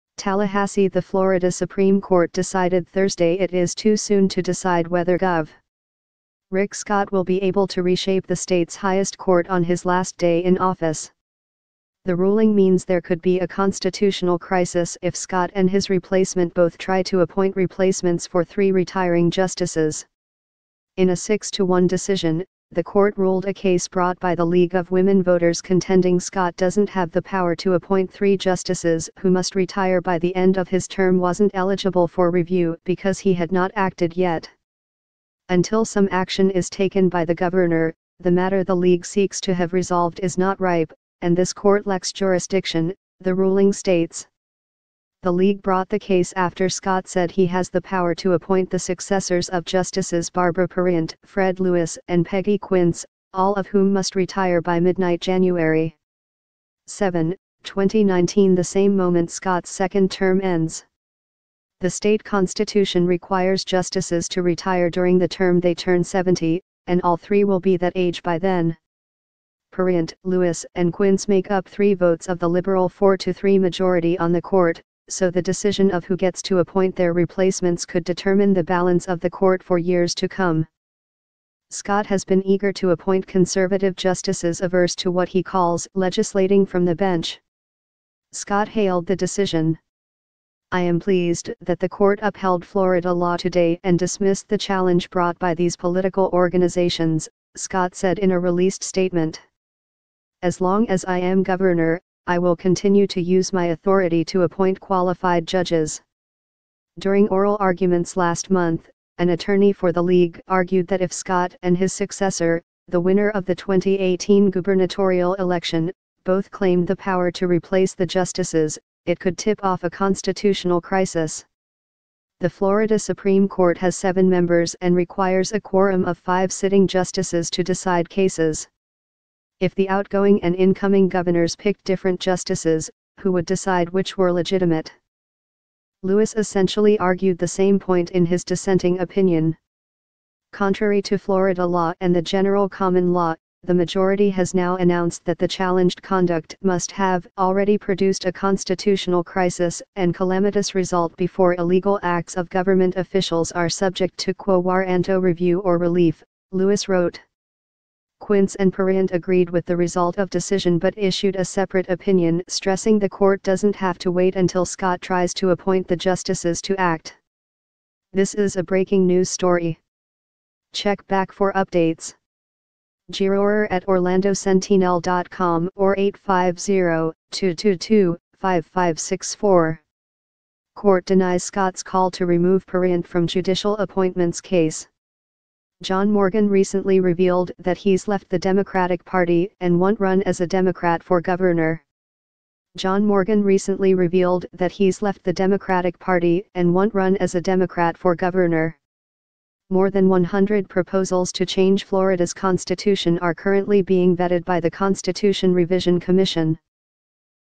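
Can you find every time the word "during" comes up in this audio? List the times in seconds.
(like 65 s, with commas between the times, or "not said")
64 s, 106 s.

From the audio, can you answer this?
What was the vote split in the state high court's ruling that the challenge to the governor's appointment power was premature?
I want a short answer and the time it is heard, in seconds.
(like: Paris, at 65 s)
6 to 1, at 21 s.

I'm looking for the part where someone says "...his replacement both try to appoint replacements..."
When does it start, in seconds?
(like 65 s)
15 s.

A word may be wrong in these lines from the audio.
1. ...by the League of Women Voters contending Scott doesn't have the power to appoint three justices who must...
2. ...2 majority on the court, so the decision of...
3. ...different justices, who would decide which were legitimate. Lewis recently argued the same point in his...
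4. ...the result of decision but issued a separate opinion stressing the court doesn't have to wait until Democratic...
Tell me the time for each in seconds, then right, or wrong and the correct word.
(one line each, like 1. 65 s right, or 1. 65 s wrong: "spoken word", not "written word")
1. 24 s right
2. 73 s wrong: "3", not "2"
3. 131 s wrong: "essentially", not "recently"
4. 159 s wrong: "Scott", not "Democratic".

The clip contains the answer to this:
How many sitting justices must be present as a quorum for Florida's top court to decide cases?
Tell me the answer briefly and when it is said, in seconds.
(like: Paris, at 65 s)
5, at 126 s.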